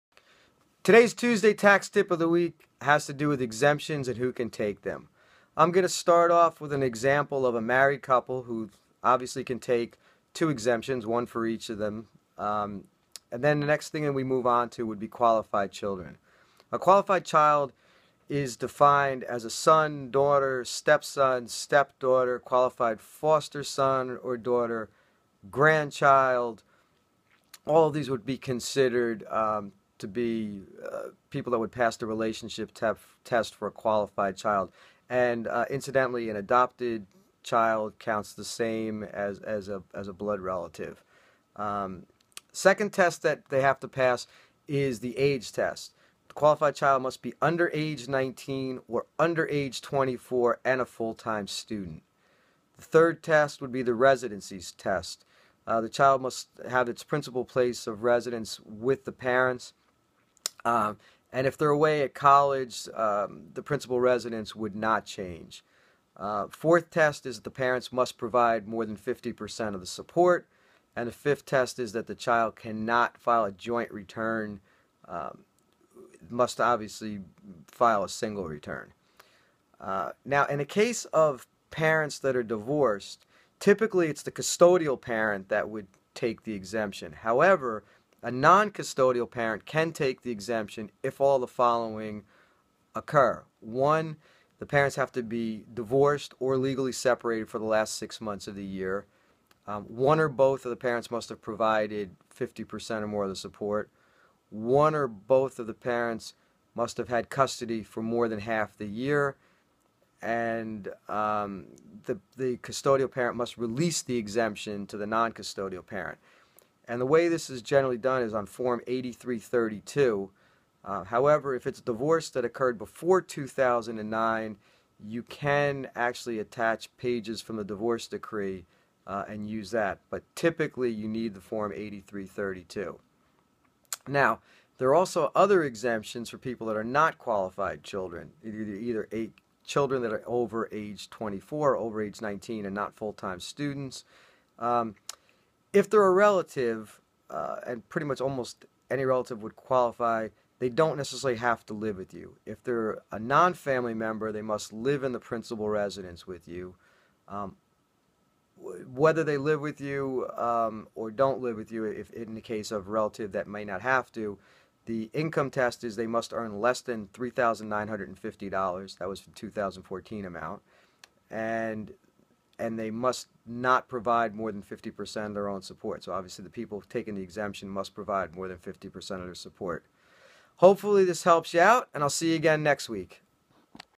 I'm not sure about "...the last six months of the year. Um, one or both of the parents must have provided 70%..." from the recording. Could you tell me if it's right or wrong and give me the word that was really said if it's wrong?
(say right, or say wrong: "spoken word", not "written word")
wrong: "50", not "70".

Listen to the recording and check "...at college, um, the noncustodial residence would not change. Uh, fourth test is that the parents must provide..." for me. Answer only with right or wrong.
wrong.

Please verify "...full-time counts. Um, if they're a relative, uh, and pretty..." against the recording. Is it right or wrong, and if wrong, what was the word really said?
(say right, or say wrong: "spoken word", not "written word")
wrong: "students", not "counts".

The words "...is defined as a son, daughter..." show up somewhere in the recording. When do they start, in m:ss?
0:18.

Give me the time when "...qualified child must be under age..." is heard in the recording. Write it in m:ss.
0:46.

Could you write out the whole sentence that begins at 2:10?
But typically, you need the Form 8332.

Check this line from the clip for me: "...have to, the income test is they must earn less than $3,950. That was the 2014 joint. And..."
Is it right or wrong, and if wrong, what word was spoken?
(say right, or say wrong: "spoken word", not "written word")
wrong: "amount", not "joint".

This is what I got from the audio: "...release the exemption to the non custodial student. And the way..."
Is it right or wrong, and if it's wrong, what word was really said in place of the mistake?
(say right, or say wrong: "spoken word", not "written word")
wrong: "parent", not "student".